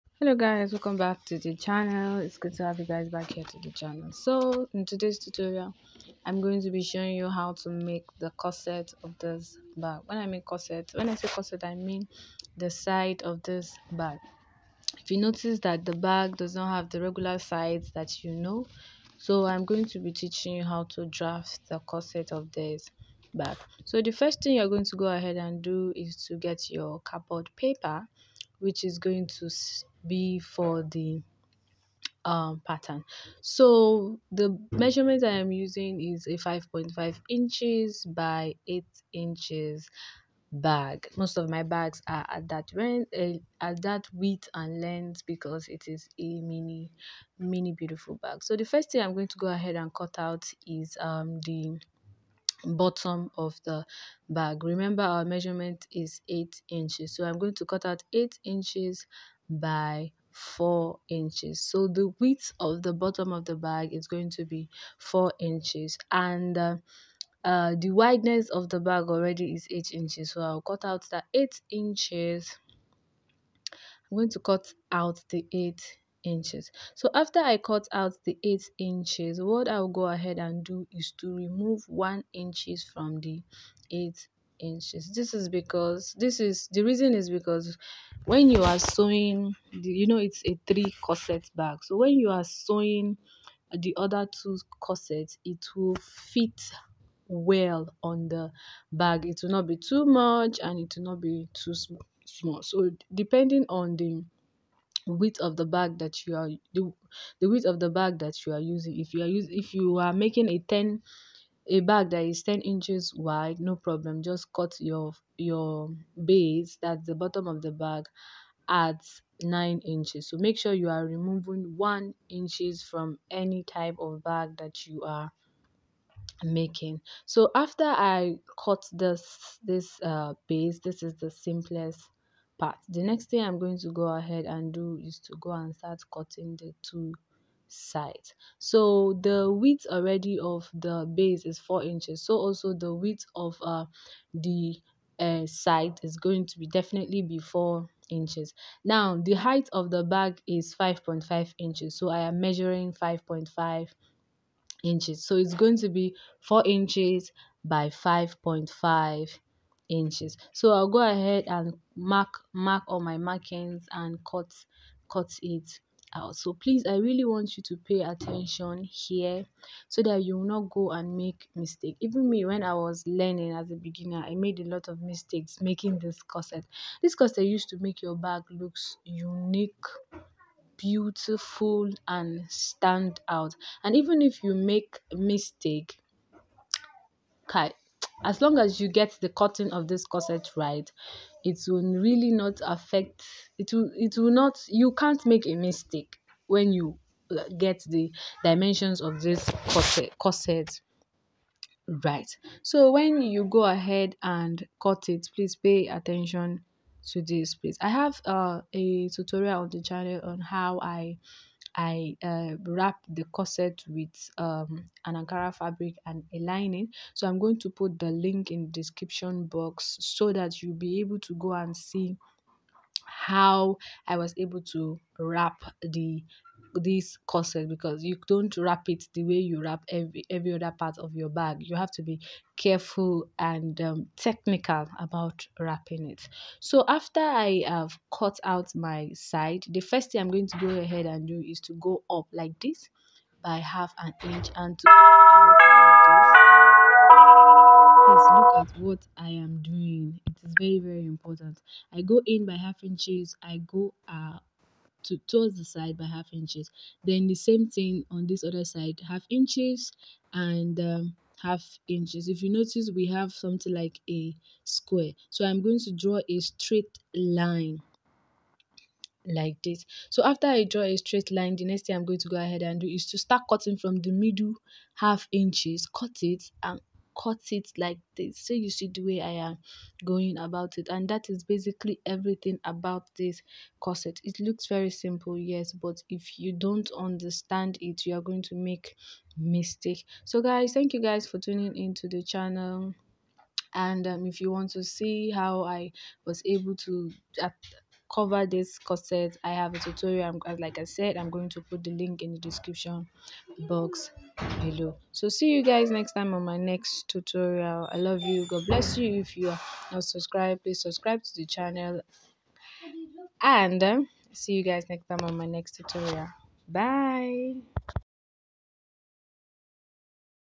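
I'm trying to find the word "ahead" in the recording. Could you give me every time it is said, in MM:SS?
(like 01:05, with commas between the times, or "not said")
00:25, 00:49, 01:20, 02:14, 02:41, 03:23, 04:00, 04:32.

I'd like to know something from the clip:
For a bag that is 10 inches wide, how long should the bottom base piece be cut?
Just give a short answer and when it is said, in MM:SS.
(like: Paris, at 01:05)
9 inches, at 01:59.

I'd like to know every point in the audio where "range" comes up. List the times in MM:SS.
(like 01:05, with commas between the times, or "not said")
00:42.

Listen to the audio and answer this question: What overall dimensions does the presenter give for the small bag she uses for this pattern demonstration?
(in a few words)
5.5 by 8 inches.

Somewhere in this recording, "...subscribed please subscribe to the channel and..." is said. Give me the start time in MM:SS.
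05:10.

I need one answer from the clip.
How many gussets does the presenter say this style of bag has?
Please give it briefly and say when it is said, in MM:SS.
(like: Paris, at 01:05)
3, at 01:30.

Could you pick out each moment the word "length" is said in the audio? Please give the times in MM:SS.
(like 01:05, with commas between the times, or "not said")
00:44.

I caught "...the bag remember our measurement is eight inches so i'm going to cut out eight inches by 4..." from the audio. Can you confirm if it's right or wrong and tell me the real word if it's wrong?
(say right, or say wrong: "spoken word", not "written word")
right.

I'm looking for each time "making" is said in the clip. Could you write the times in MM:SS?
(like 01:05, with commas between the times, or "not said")
01:50, 02:06, 02:55.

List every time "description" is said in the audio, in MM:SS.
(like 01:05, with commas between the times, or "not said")
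03:38, 05:02.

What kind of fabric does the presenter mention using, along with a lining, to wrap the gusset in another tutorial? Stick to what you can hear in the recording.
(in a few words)
Ankara.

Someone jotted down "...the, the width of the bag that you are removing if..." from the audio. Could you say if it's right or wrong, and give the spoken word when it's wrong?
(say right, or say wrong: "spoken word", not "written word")
wrong: "using", not "removing".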